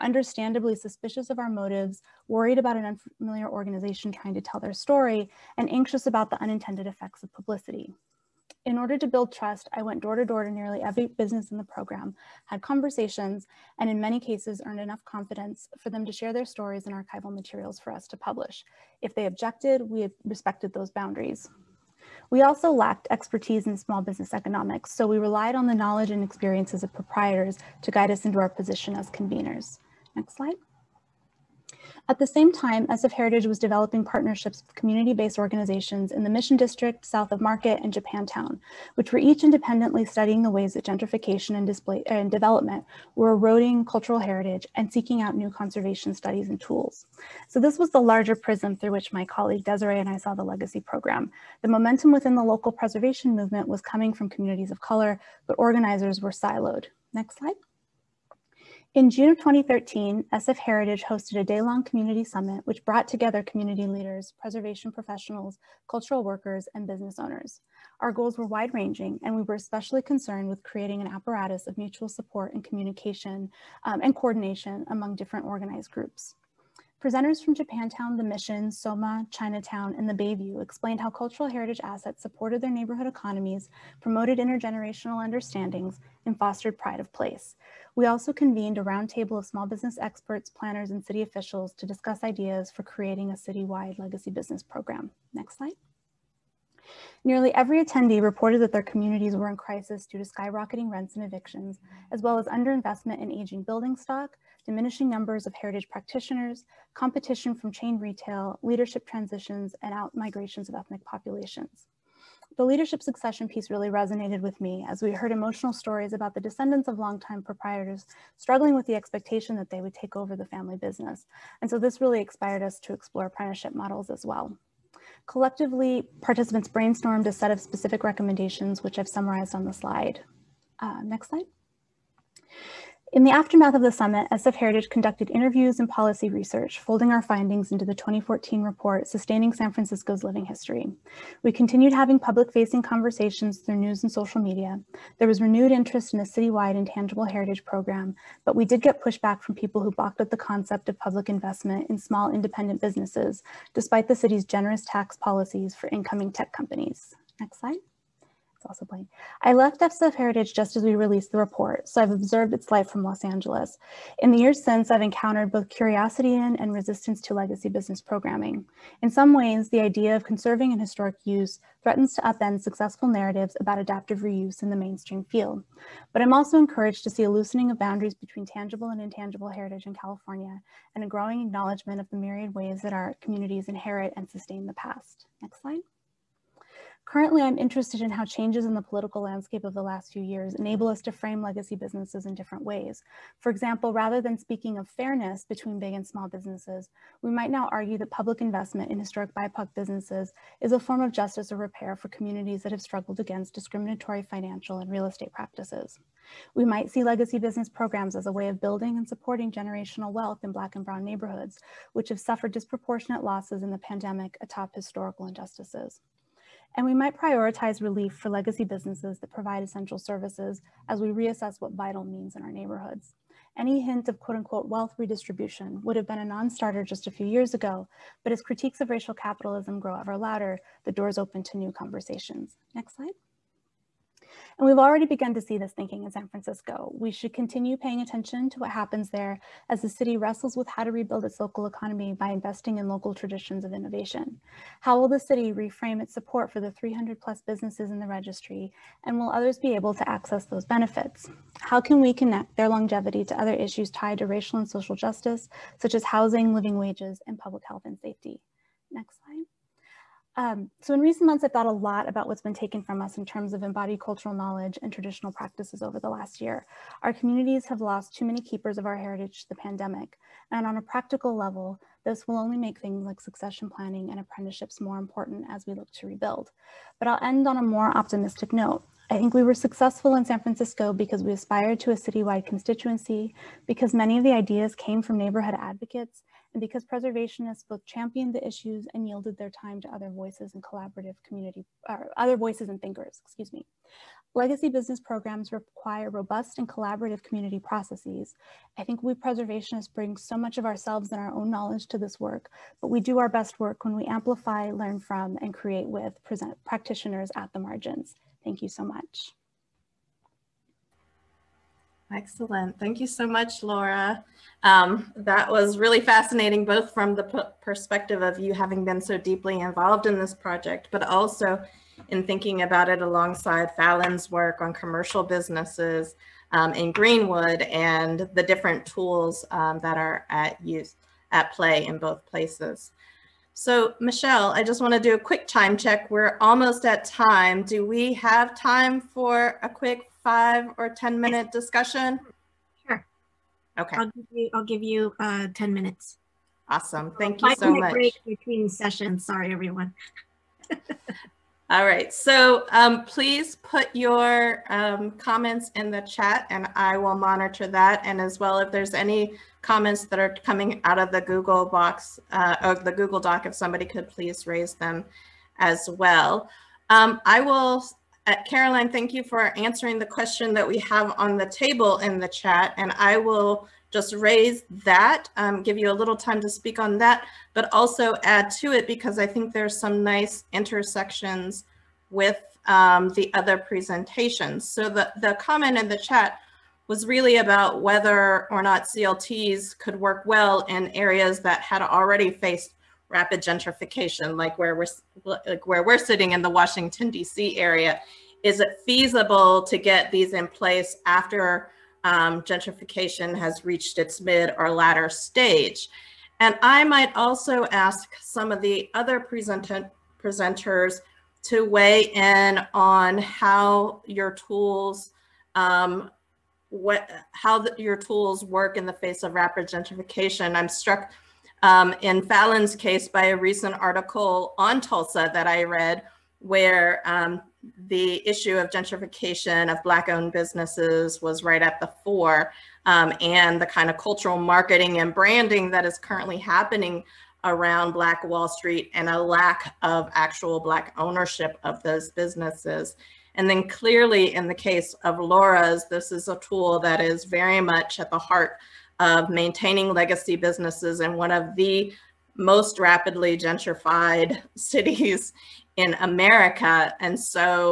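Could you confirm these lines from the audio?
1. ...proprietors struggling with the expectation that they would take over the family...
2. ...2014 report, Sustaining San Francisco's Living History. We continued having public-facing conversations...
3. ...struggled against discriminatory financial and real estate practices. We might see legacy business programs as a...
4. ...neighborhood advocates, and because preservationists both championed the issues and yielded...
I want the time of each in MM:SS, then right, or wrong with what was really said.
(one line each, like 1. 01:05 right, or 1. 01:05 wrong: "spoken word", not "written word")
1. 01:57 right
2. 02:17 right
3. 03:22 right
4. 04:45 right.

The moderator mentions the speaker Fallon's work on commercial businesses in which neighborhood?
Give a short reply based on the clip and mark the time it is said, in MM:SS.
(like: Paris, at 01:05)
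Greenwood, at 05:26.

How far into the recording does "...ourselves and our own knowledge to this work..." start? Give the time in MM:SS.
05:00.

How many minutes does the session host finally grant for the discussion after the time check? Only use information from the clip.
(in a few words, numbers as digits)
10.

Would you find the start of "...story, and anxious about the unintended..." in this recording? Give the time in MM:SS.
00:04.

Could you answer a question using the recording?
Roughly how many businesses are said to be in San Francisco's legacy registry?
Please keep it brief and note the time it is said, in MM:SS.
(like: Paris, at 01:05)
300 plus, at 04:06.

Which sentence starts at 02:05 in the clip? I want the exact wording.
Collectively, participants brainstormed a set of specific recommendations, which I've summarized on the slide.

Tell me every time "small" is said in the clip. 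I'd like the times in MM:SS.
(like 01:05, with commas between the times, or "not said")
00:23, 01:29, 02:31, 03:16.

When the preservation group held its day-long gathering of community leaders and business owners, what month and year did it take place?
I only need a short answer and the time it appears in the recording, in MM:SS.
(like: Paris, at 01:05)
June 2013, at 00:59.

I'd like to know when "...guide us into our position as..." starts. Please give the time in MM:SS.
00:27.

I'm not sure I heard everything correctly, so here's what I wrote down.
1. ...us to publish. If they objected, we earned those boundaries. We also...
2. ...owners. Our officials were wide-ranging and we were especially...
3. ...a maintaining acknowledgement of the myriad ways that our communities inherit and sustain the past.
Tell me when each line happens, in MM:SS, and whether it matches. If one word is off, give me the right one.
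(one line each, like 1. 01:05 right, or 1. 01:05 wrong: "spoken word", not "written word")
1. 00:17 wrong: "respected", not "earned"
2. 01:07 wrong: "goals", not "officials"
3. 03:01 wrong: "growing", not "maintaining".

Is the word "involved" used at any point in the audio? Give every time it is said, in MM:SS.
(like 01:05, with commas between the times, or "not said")
05:19.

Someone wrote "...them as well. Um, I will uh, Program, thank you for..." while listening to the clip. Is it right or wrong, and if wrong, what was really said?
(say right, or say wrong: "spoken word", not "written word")
wrong: "Caroline", not "Program".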